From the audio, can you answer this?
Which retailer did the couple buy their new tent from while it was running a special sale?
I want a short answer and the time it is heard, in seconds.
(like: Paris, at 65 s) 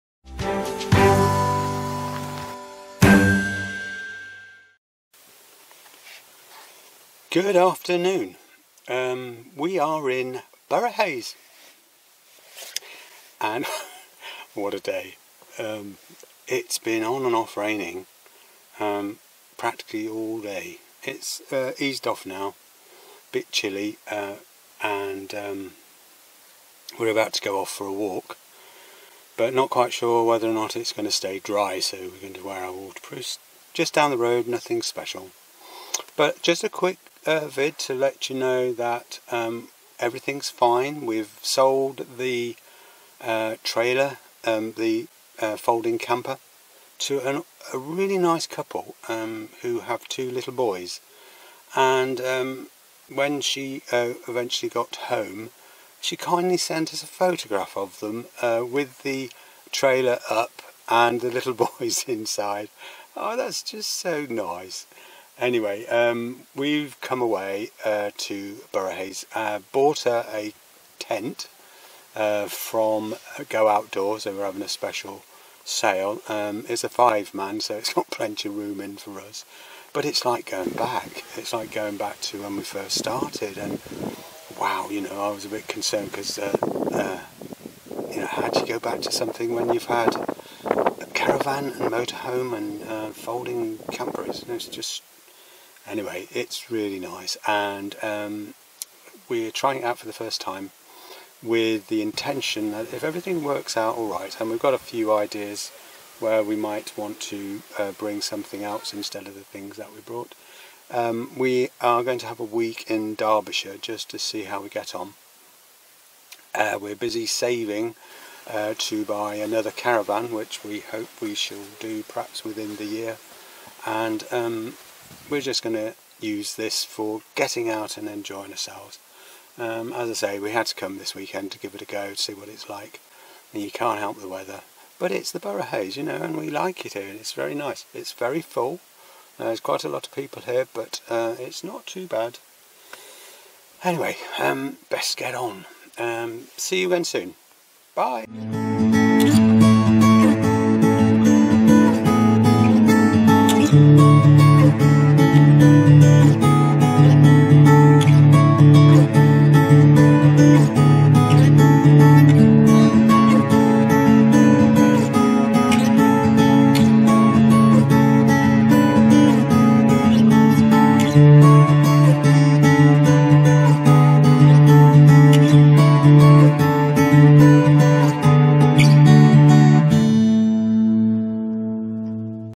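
Go Outdoors, at 73 s.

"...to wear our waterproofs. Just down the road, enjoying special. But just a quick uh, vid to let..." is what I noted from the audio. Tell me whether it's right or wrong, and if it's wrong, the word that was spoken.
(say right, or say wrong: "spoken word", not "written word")
wrong: "nothing", not "enjoying".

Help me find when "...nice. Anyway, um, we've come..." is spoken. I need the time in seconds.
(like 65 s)
64 s.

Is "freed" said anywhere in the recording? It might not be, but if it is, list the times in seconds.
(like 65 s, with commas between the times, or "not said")
not said.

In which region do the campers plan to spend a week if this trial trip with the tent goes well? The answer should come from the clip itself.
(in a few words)
Derbyshire.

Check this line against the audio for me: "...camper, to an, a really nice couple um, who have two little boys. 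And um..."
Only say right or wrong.
right.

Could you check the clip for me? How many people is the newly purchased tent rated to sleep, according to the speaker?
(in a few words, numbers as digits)
5.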